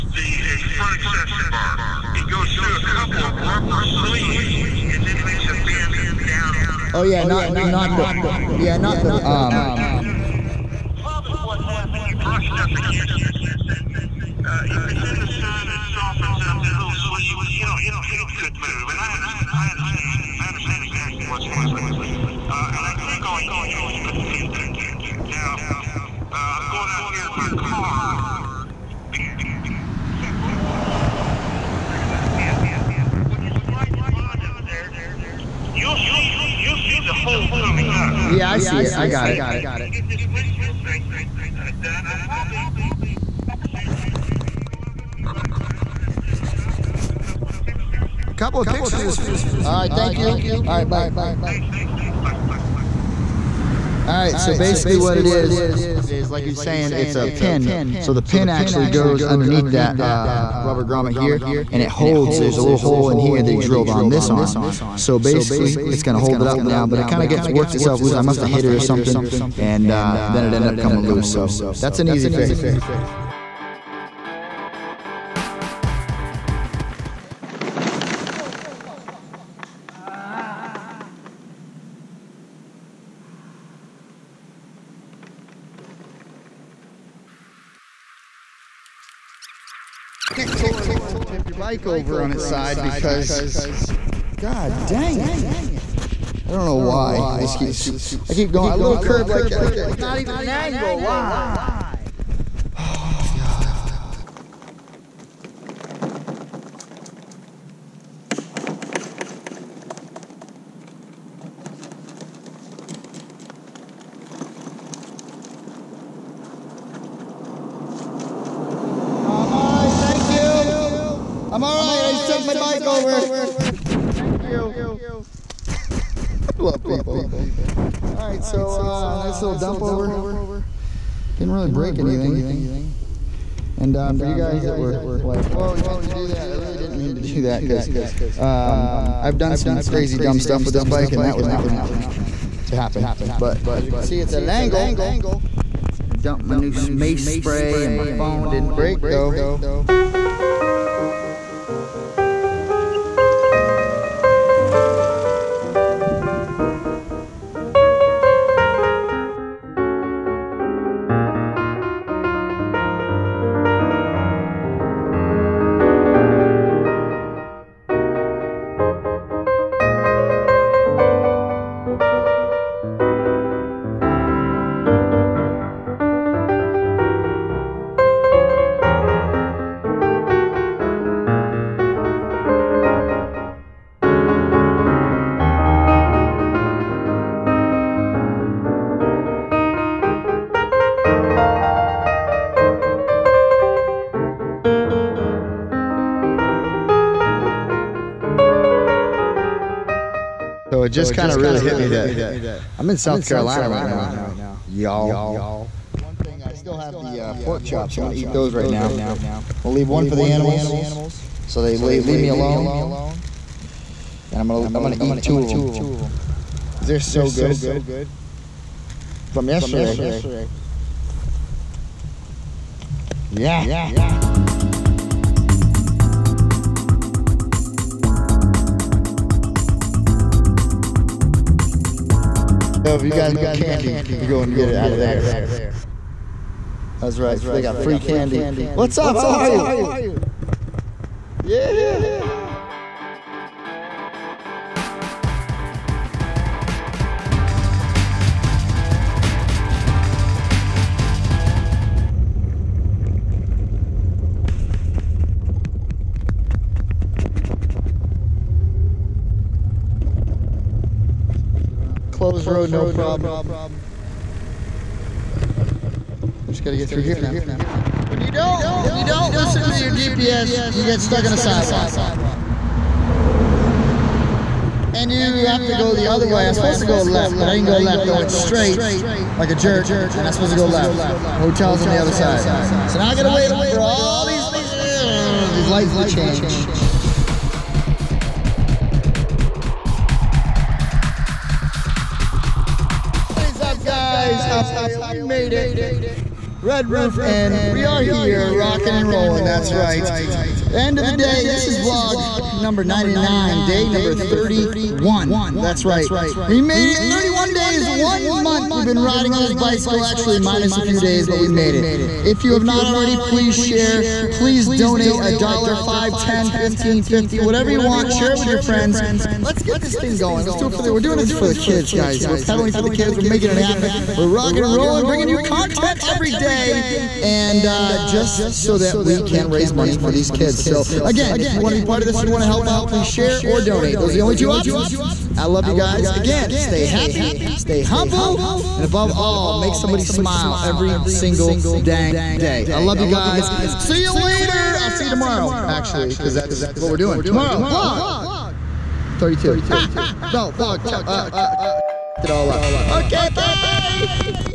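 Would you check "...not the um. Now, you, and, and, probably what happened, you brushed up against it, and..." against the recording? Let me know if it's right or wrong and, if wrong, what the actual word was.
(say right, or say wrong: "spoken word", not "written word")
right.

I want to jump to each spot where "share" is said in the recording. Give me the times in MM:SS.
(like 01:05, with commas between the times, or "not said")
05:13, 05:18, 05:33.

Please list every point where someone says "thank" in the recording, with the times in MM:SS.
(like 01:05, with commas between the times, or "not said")
00:49, 02:03.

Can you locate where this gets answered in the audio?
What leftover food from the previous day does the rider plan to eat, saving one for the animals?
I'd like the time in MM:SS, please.
03:27.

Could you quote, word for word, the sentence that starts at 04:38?
I went straight like a jerk, and I'm supposed to go left.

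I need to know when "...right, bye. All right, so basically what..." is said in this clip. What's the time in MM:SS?
00:50.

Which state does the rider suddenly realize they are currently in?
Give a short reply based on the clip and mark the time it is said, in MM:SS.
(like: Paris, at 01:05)
South Carolina, at 03:22.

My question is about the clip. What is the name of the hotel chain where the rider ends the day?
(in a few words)
Red Roof.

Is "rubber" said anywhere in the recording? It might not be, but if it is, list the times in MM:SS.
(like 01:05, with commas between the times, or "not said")
00:03, 01:00.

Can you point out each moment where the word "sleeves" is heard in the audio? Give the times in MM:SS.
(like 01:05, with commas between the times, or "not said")
00:03, 00:16.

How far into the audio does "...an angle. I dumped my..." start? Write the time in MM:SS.
02:24.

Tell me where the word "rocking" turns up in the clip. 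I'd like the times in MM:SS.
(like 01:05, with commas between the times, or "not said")
04:58, 05:24.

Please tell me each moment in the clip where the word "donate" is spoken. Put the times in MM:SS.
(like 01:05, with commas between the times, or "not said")
05:14, 05:33.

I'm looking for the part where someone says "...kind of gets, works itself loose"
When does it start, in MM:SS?
01:07.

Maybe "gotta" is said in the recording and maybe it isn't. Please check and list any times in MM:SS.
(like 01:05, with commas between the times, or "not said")
04:26, 04:43.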